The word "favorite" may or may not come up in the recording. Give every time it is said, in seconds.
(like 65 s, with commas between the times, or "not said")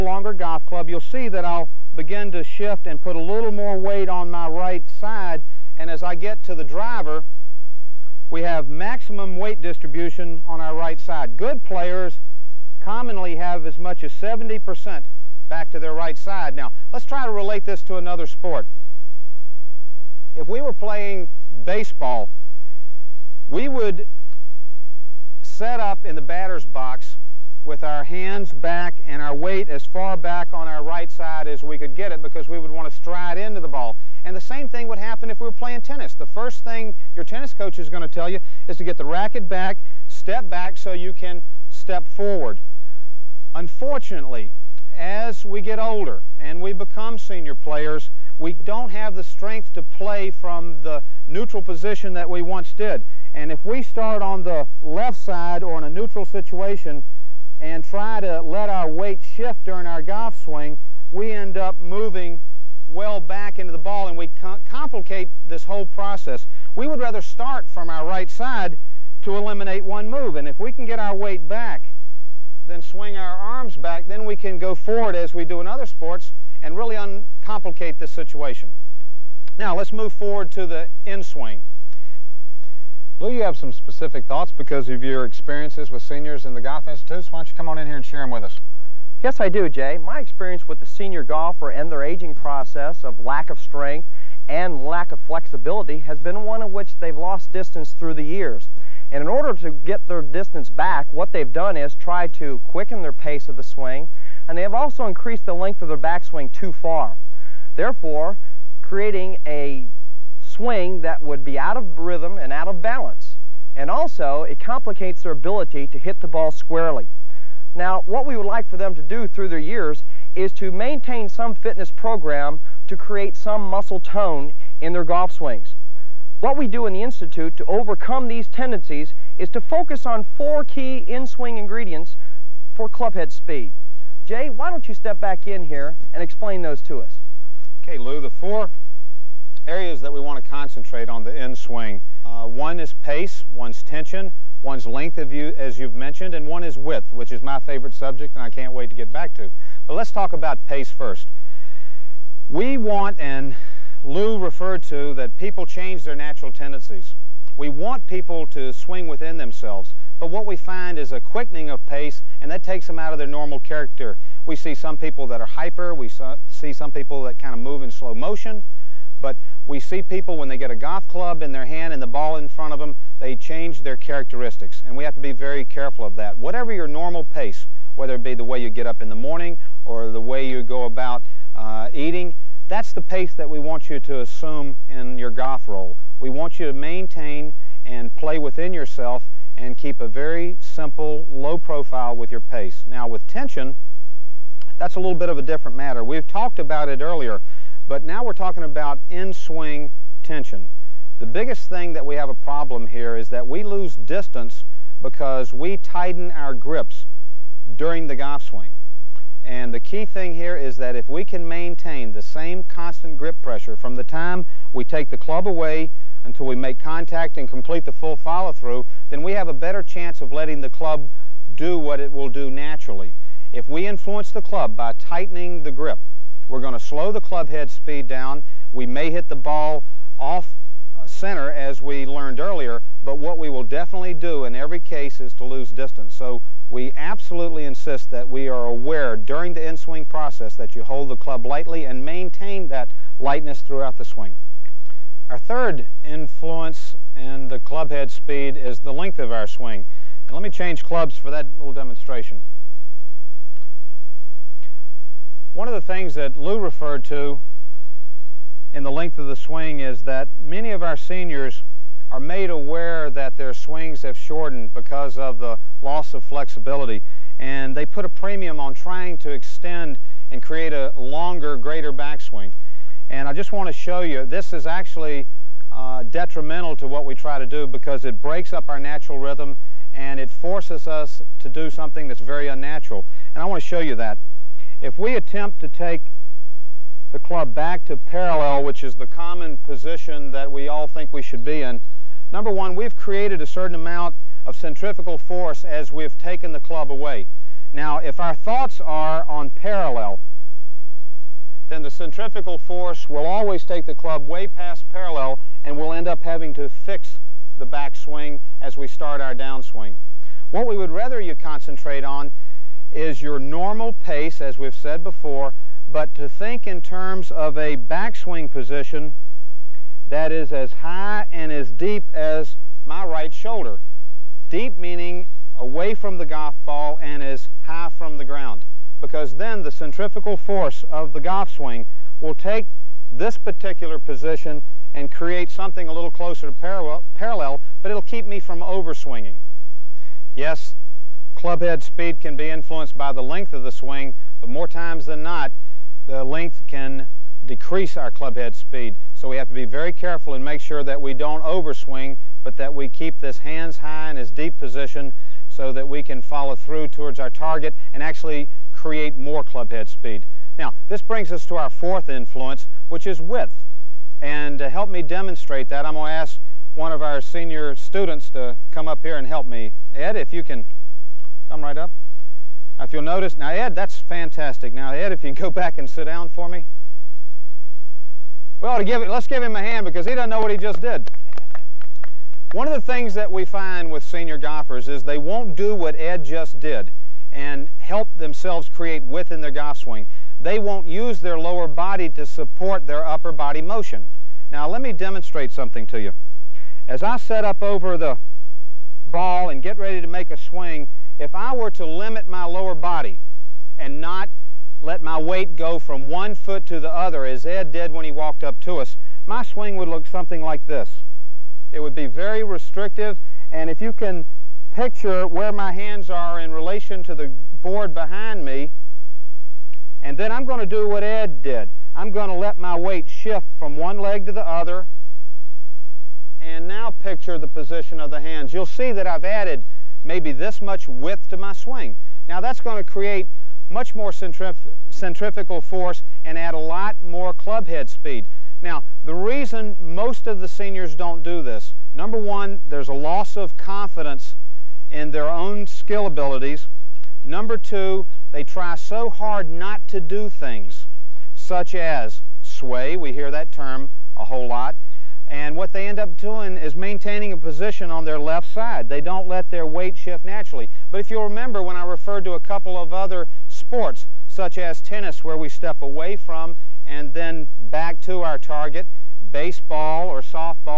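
147 s.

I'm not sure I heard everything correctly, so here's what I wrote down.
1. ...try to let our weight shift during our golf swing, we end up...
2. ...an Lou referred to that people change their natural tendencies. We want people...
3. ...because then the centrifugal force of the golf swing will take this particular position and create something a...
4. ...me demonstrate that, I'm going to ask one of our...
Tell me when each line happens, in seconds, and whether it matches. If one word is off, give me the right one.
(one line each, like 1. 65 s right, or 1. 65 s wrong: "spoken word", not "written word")
1. 57 s right
2. 153 s right
3. 329 s right
4. 364 s right.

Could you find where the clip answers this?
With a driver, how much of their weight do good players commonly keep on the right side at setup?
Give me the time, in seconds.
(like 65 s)
14 s.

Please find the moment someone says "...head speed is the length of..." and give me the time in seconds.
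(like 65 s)
247 s.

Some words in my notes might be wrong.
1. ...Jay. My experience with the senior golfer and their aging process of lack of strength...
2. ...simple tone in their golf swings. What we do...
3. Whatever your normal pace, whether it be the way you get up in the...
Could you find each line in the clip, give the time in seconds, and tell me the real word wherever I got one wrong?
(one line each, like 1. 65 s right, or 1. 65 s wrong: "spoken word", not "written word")
1. 89 s right
2. 123 s wrong: "muscle", not "simple"
3. 176 s right.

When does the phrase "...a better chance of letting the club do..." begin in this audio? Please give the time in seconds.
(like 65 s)
219 s.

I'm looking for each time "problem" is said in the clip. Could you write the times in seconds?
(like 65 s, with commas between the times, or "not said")
202 s.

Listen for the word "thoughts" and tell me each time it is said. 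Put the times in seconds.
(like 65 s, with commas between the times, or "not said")
84 s, 298 s.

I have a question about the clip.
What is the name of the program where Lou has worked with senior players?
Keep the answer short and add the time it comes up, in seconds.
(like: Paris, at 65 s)
Golf Institutes, at 86 s.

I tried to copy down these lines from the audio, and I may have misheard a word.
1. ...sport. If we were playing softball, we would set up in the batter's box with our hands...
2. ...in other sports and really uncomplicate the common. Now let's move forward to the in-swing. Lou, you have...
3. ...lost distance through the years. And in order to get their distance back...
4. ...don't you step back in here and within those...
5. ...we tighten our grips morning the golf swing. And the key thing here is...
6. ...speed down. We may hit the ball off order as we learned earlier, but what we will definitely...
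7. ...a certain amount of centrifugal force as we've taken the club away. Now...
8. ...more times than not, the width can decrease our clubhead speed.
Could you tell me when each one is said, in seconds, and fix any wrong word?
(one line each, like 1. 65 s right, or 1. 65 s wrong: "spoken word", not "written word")
1. 18 s wrong: "baseball", not "softball"
2. 75 s wrong: "situation", not "common"
3. 97 s right
4. 134 s wrong: "explain", not "within"
5. 205 s wrong: "during", not "morning"
6. 227 s wrong: "center", not "order"
7. 293 s right
8. 344 s wrong: "length", not "width".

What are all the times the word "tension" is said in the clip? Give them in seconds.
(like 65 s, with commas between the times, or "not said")
143 s, 193 s, 200 s.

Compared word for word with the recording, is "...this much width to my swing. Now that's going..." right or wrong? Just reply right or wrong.
right.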